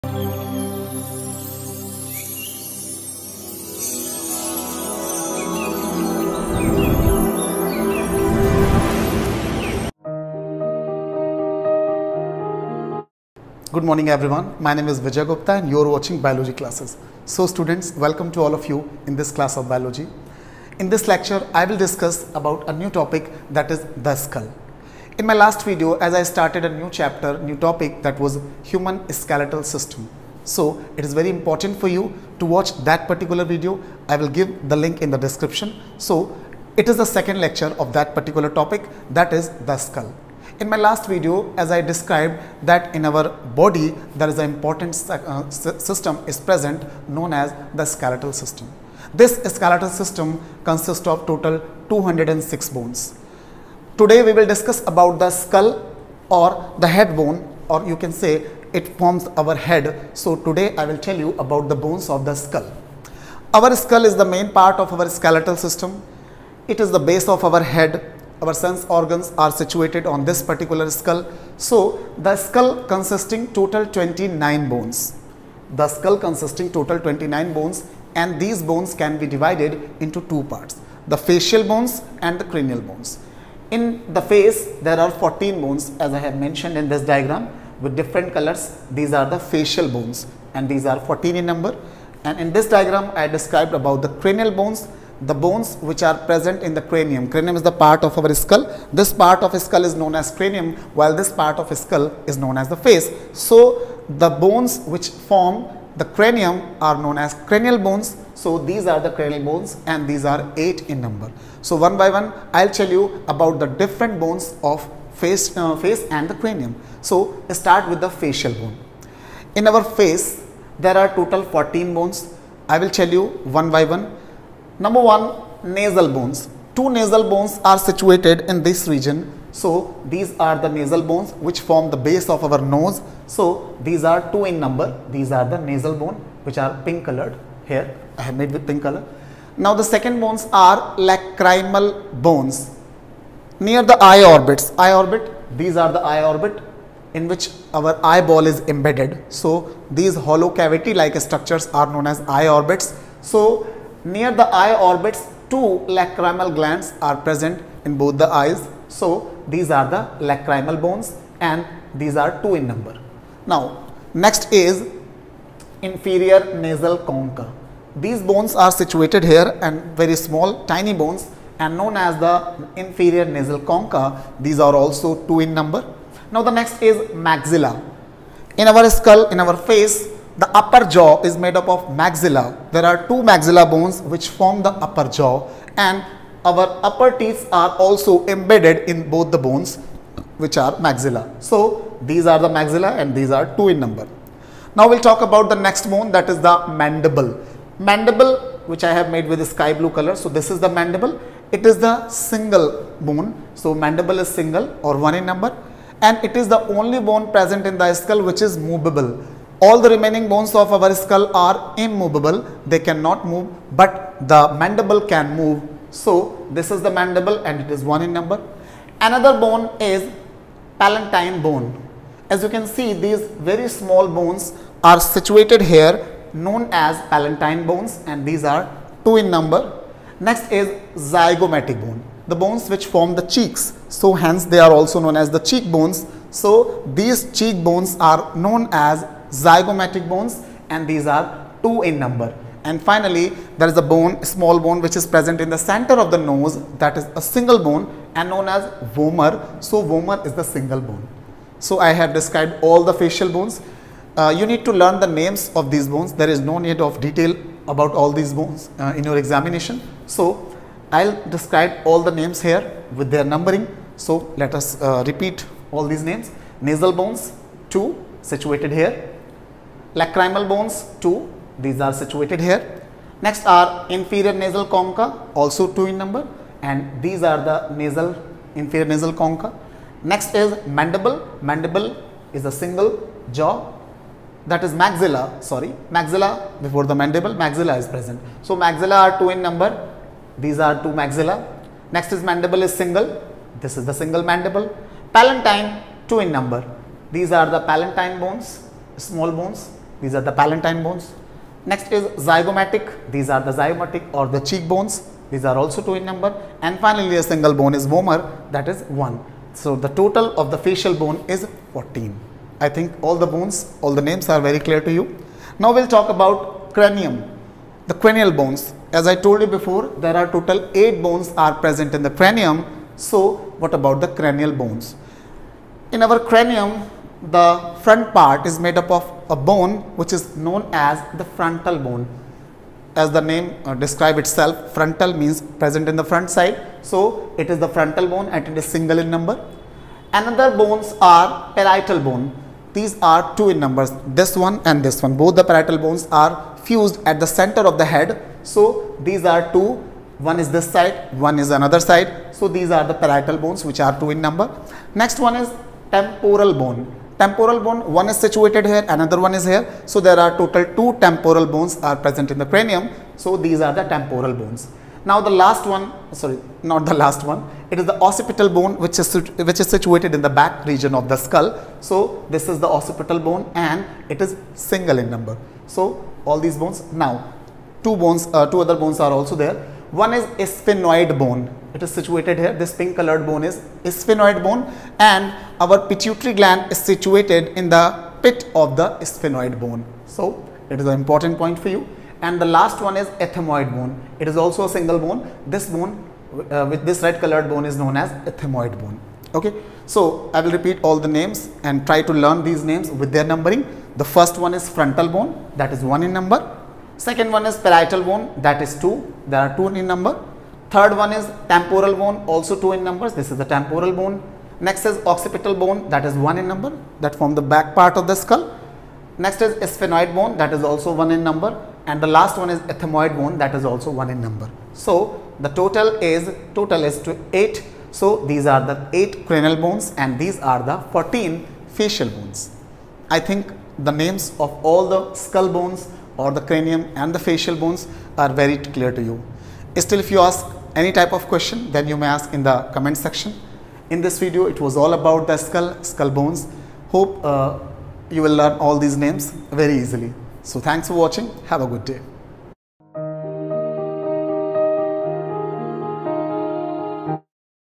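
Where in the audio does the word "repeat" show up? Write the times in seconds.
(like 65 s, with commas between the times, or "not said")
265 s, 400 s.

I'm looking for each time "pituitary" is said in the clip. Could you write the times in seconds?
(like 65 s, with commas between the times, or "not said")
385 s.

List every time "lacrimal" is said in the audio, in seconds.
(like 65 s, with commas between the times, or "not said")
140 s, 155 s, 160 s, 269 s.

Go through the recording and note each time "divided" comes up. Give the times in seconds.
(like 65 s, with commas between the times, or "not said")
79 s.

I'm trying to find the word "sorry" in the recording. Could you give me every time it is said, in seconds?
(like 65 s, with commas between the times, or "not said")
285 s, 366 s.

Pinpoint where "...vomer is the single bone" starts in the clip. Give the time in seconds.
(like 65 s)
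249 s.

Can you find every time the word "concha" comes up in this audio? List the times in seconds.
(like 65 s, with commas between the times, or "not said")
166 s, 173 s, 274 s, 279 s.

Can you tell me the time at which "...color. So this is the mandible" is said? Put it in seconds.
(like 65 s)
199 s.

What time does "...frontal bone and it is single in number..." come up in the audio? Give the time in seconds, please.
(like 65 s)
337 s.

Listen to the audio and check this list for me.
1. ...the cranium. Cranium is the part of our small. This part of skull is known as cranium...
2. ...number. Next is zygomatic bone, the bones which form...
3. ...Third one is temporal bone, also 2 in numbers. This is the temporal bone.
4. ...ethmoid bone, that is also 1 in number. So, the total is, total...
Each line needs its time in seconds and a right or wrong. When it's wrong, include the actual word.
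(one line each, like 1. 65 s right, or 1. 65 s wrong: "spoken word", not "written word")
1. 96 s wrong: "skull", not "small"
2. 229 s right
3. 410 s right
4. 422 s right.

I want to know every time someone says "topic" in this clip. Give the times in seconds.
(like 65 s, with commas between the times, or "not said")
22 s, 27 s, 38 s.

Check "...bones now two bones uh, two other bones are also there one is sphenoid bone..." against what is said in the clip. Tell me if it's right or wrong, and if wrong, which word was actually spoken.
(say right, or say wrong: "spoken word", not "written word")
right.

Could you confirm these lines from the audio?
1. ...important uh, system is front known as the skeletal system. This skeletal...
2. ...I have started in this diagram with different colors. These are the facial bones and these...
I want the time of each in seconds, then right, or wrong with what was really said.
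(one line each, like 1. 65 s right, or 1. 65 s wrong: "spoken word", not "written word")
1. 44 s wrong: "present", not "front"
2. 86 s wrong: "mentioned", not "started".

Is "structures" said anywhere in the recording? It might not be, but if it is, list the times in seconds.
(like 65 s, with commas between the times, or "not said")
151 s.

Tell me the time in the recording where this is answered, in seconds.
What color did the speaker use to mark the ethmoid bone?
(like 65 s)
397 s.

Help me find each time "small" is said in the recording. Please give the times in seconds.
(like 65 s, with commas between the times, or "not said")
170 s, 223 s, 244 s, 298 s.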